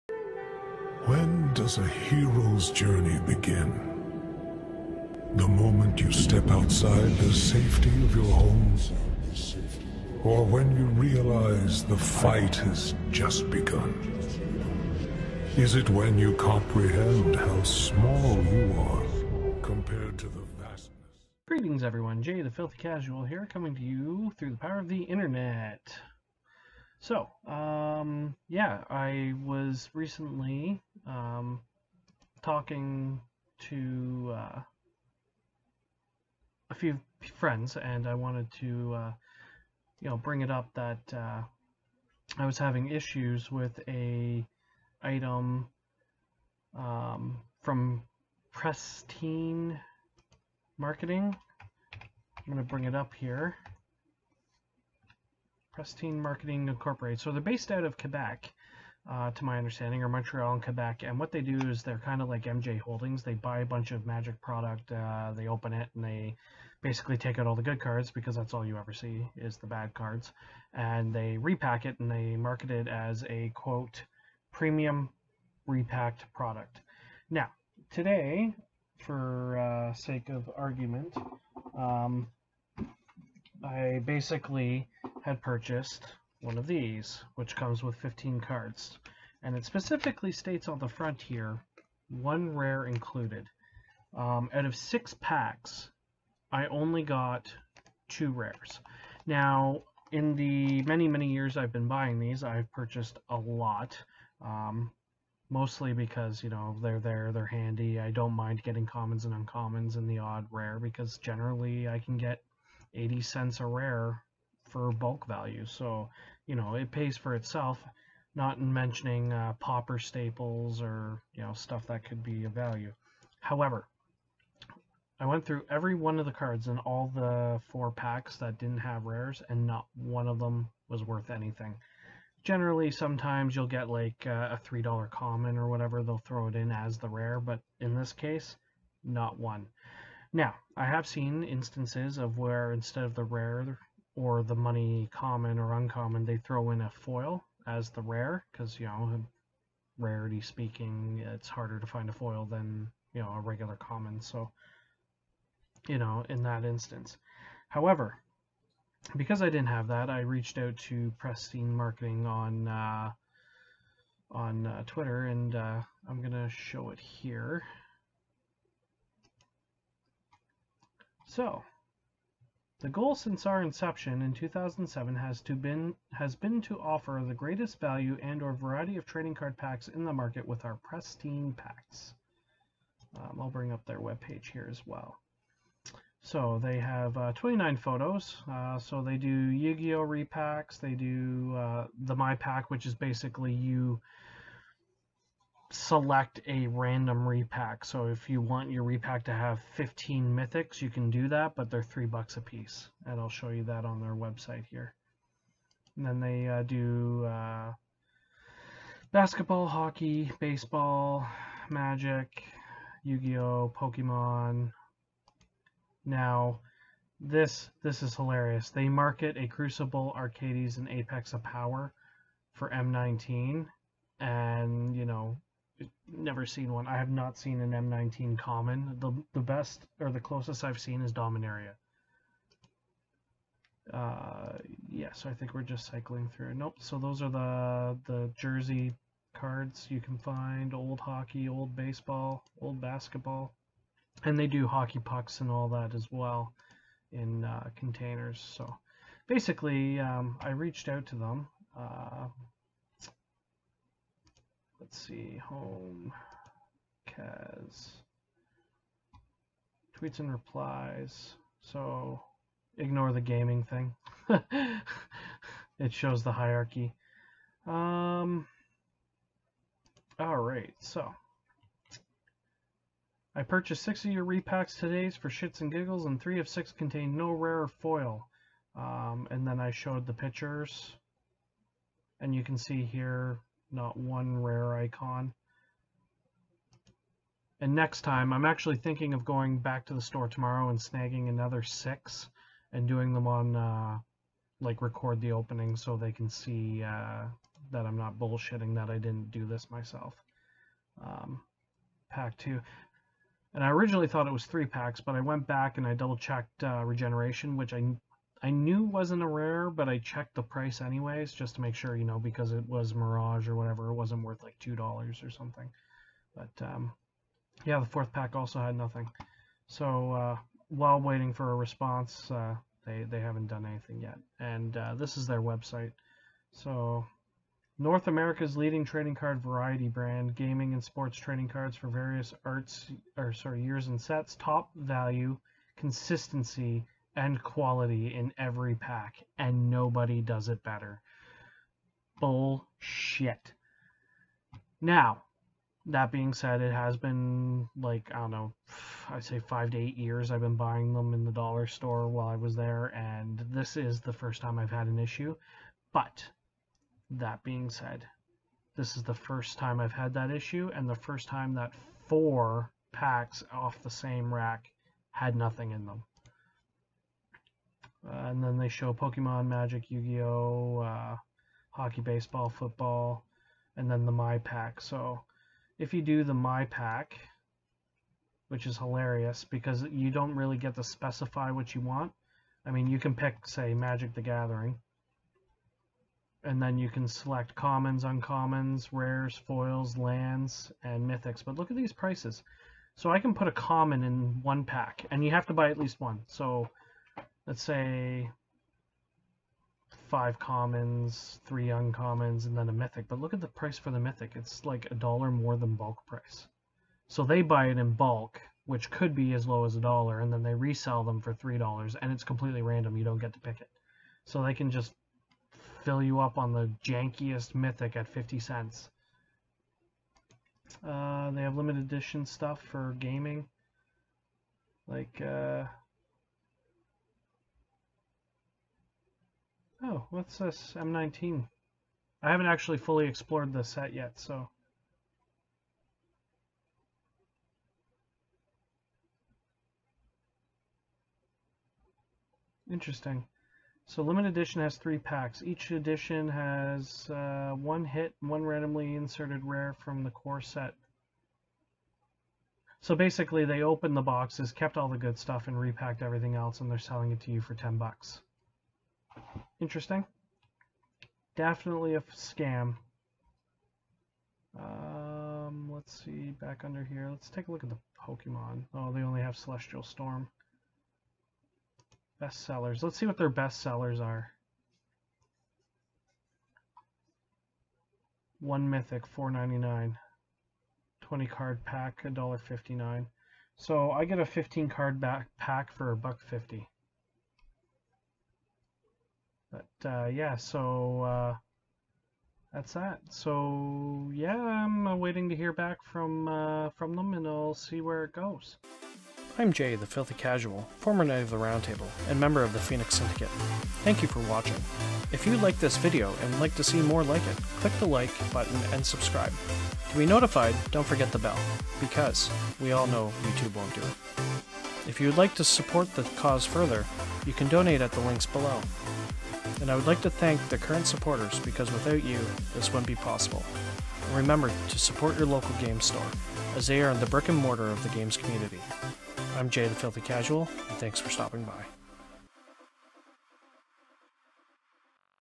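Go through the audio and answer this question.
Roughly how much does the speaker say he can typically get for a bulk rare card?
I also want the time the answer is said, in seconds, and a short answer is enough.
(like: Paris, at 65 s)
80 cents, at 112 s.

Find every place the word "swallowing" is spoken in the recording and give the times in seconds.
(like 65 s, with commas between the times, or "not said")
not said.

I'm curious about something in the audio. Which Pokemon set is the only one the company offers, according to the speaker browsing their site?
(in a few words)
Celestial Storm.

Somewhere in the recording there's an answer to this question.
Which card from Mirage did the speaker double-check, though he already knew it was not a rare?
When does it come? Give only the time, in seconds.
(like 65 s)
306 s.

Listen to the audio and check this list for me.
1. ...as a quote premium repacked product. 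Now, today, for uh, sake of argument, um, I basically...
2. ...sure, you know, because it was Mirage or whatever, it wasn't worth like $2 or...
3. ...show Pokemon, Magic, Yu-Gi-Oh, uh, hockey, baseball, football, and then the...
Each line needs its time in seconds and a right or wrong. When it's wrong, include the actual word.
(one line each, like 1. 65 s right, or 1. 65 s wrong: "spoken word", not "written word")
1. 72 s right
2. 311 s right
3. 368 s right.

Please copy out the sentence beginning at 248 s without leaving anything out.
So basically, um, I reached out to them.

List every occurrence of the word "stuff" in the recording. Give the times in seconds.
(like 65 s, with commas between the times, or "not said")
121 s, 422 s, 455 s.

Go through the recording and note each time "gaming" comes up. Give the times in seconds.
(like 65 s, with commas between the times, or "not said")
263 s, 330 s, 422 s.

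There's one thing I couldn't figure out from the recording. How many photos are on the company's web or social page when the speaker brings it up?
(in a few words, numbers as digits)
29.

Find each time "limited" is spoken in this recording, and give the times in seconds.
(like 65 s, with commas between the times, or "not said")
421 s, 444 s.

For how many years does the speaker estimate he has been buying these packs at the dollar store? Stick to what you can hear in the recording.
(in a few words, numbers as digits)
5 to 8 years.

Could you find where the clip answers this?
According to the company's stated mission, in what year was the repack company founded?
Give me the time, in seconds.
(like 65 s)
174 s.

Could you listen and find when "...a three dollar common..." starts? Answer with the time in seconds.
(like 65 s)
134 s.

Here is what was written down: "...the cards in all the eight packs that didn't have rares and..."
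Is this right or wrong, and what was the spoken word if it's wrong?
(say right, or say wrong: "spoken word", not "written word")
wrong: "four", not "eight".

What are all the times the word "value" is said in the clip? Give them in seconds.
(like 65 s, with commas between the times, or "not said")
115 s, 122 s, 177 s, 334 s.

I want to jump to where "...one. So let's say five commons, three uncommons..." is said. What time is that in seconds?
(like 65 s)
395 s.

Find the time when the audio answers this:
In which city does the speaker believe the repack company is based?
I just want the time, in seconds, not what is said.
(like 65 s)
60 s.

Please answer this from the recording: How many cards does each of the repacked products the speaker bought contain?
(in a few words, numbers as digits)
15.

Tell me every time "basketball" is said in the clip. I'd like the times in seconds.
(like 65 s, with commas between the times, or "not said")
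209 s, 242 s.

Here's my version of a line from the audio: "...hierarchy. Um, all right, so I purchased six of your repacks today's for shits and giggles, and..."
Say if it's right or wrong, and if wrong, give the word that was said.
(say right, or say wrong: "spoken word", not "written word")
right.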